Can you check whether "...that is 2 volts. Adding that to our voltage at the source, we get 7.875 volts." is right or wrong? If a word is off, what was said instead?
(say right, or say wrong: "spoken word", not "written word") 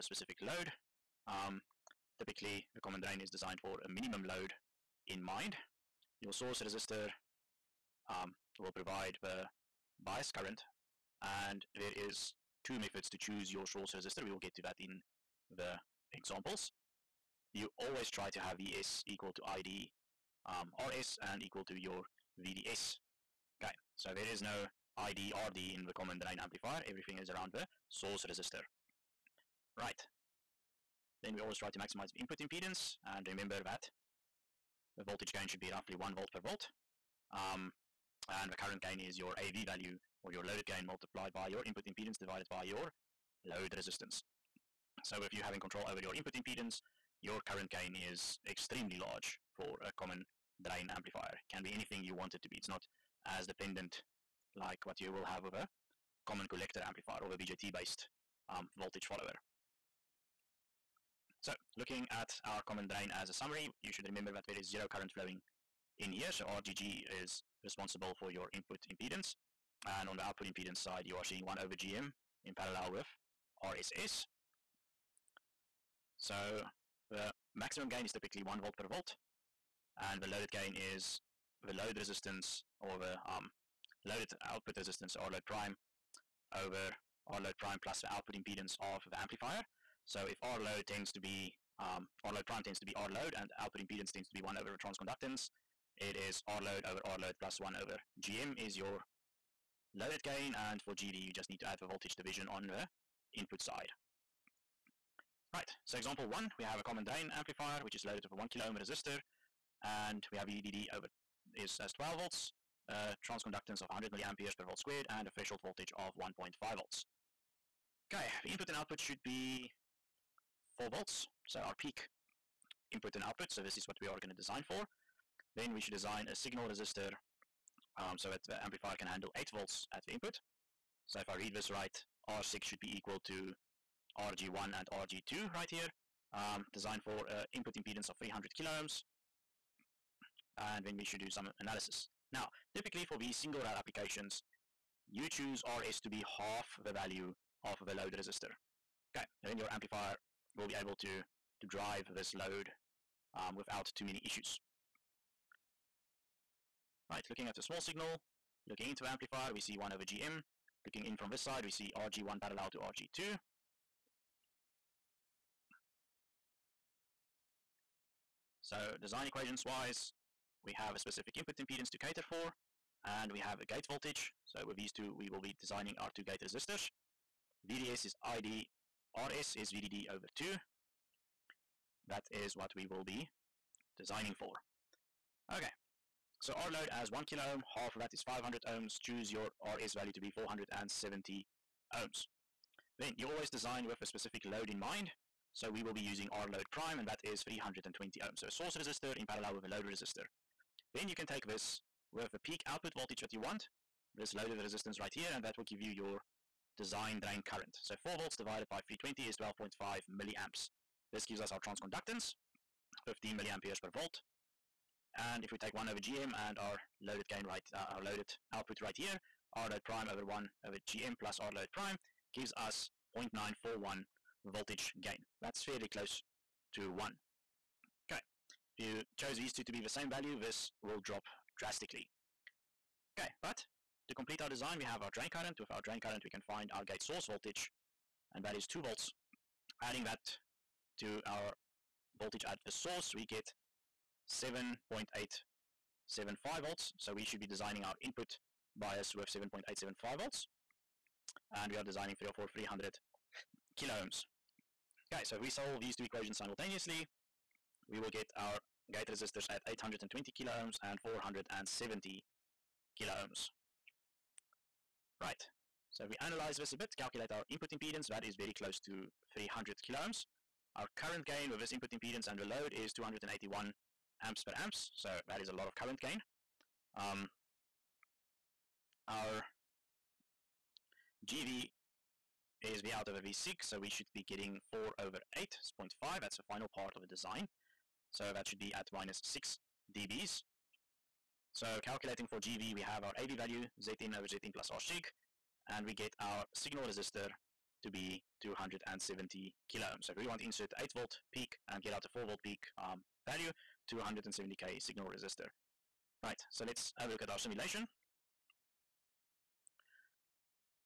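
right.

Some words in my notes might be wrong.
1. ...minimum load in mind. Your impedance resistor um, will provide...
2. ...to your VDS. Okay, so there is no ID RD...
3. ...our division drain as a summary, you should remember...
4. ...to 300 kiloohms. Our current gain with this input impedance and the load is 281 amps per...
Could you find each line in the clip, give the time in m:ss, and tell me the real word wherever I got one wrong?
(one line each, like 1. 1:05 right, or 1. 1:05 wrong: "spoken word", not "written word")
1. 0:03 wrong: "source", not "impedance"
2. 0:21 right
3. 1:02 wrong: "common", not "division"
4. 4:28 right.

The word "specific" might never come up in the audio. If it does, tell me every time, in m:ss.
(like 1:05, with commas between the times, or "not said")
0:00, 2:50, 3:14.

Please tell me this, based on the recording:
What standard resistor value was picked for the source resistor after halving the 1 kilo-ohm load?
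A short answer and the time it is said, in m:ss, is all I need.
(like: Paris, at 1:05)
470 ohms, at 3:10.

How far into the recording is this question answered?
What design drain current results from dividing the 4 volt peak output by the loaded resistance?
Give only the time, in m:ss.
3:29.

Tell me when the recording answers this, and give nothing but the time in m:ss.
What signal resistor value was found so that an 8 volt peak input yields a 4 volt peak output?
4:58.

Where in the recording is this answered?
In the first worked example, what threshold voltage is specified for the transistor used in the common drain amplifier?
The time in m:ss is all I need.
1:56.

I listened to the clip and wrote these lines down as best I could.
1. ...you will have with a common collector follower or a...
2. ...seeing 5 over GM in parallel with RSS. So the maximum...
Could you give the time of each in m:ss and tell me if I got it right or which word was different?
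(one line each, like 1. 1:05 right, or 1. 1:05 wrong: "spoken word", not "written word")
1. 0:54 wrong: "amplifier", not "follower"
2. 1:11 wrong: "1", not "5".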